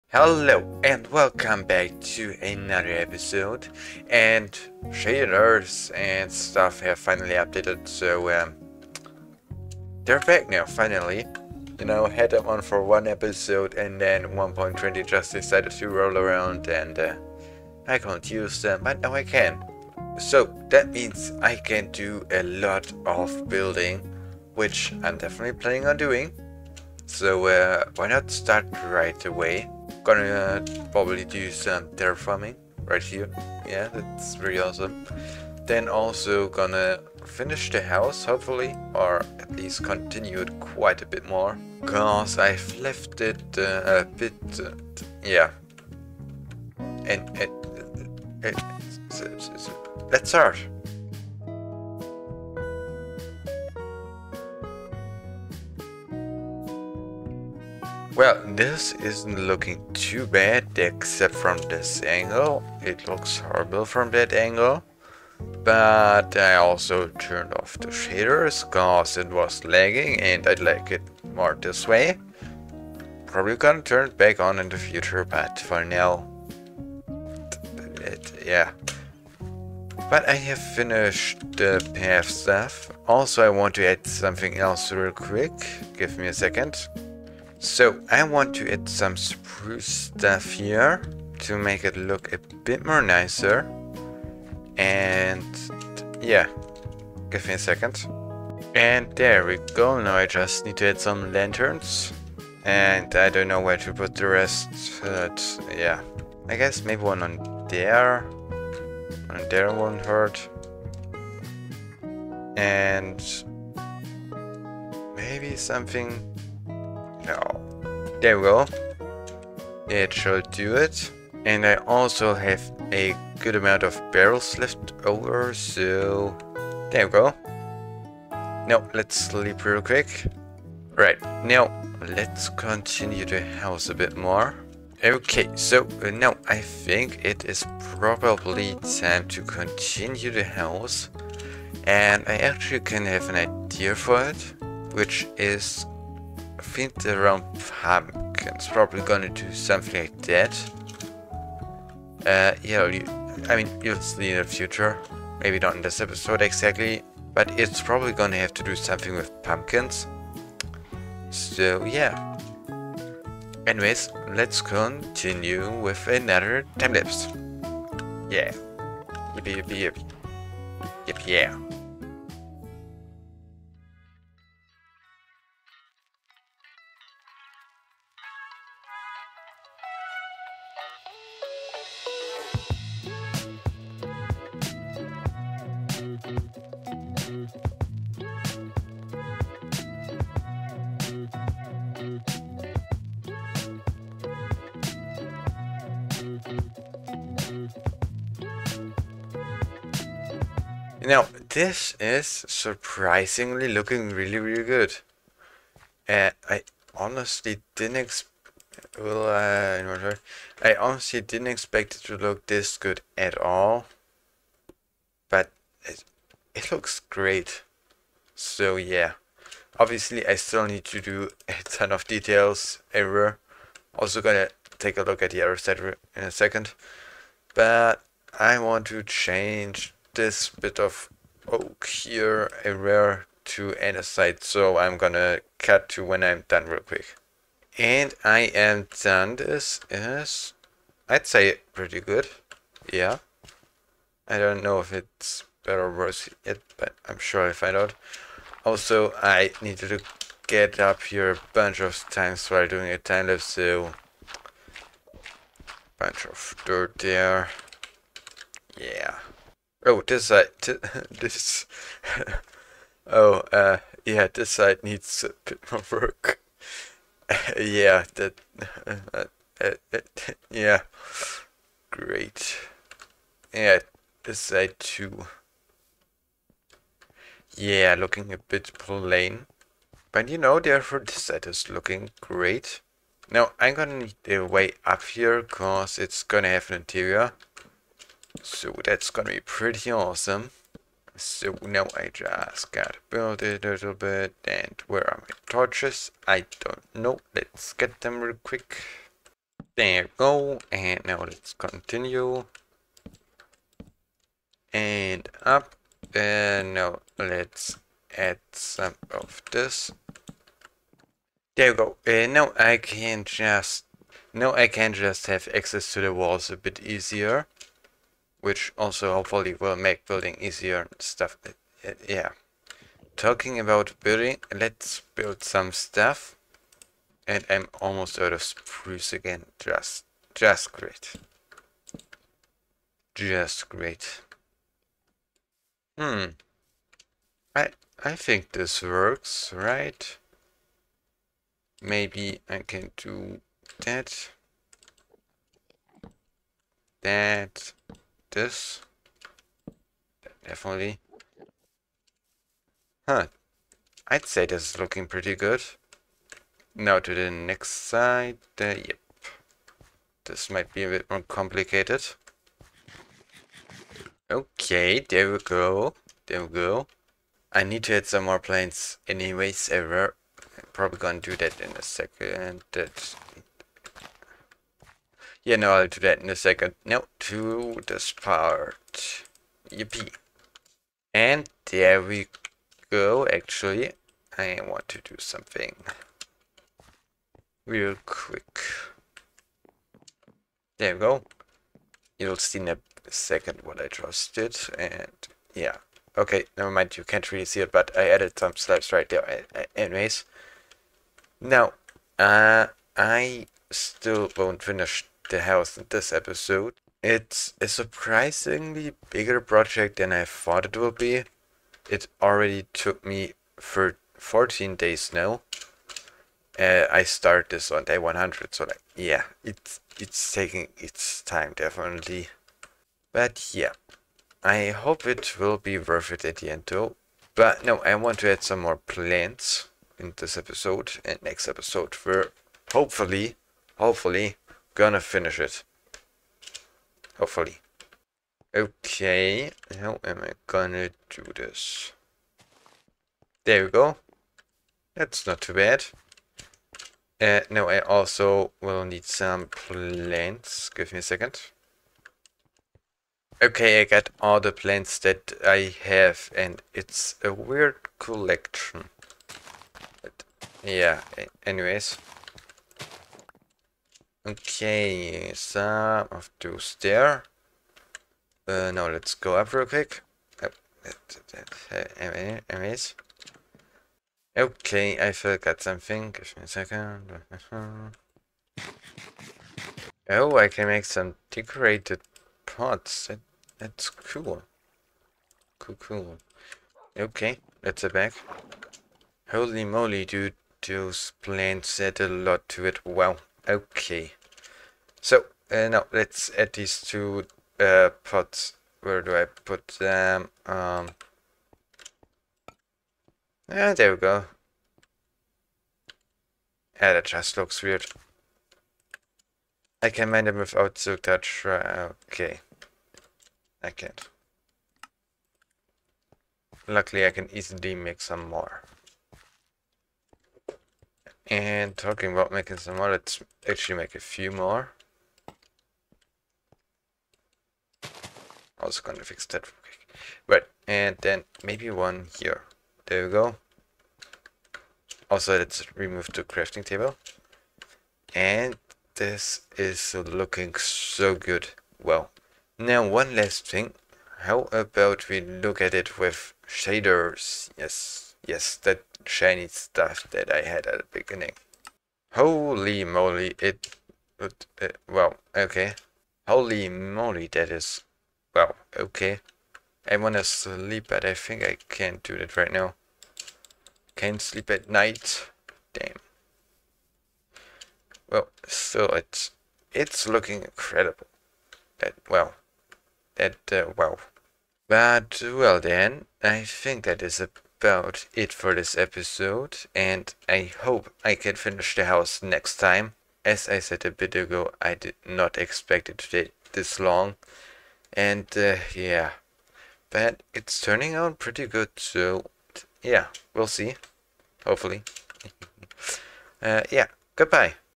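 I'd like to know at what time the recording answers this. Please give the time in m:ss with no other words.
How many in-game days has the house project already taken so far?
6:54.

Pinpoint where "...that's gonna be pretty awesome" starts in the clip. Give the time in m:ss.
4:48.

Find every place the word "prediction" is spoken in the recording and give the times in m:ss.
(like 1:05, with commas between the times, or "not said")
not said.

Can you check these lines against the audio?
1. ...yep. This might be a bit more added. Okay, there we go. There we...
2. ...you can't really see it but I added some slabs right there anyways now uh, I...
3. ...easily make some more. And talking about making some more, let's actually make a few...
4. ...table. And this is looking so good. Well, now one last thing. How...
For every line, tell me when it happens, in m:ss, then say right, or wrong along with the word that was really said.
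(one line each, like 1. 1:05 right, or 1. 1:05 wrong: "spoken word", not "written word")
1. 5:58 wrong: "complicated", not "added"
2. 6:36 right
3. 8:37 right
4. 8:56 right.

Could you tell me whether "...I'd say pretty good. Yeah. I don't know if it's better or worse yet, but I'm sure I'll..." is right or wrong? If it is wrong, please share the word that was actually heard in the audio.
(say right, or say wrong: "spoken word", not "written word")
right.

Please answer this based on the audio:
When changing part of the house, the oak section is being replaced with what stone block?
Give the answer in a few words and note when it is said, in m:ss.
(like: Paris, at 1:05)
Andesite, at 3:53.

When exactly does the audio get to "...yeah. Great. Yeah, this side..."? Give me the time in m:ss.
4:30.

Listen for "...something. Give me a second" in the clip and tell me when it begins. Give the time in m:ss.
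7:55.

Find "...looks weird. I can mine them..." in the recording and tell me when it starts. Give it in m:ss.
8:27.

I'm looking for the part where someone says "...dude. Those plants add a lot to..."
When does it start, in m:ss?
8:10.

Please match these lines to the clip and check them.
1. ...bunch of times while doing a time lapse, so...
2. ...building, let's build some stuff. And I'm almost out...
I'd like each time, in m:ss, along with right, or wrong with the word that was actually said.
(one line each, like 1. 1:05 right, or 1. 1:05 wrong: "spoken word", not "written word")
1. 4:11 right
2. 5:24 right.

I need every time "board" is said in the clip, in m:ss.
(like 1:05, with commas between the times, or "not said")
not said.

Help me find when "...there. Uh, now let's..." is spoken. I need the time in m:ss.
7:46.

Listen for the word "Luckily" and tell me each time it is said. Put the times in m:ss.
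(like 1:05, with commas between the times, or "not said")
8:36.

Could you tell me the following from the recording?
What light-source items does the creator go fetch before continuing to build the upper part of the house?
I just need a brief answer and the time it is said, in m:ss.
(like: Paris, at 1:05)
Torches, at 4:55.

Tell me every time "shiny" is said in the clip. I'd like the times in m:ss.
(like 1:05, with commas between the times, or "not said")
9:09.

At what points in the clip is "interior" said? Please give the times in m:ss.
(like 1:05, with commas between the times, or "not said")
4:46.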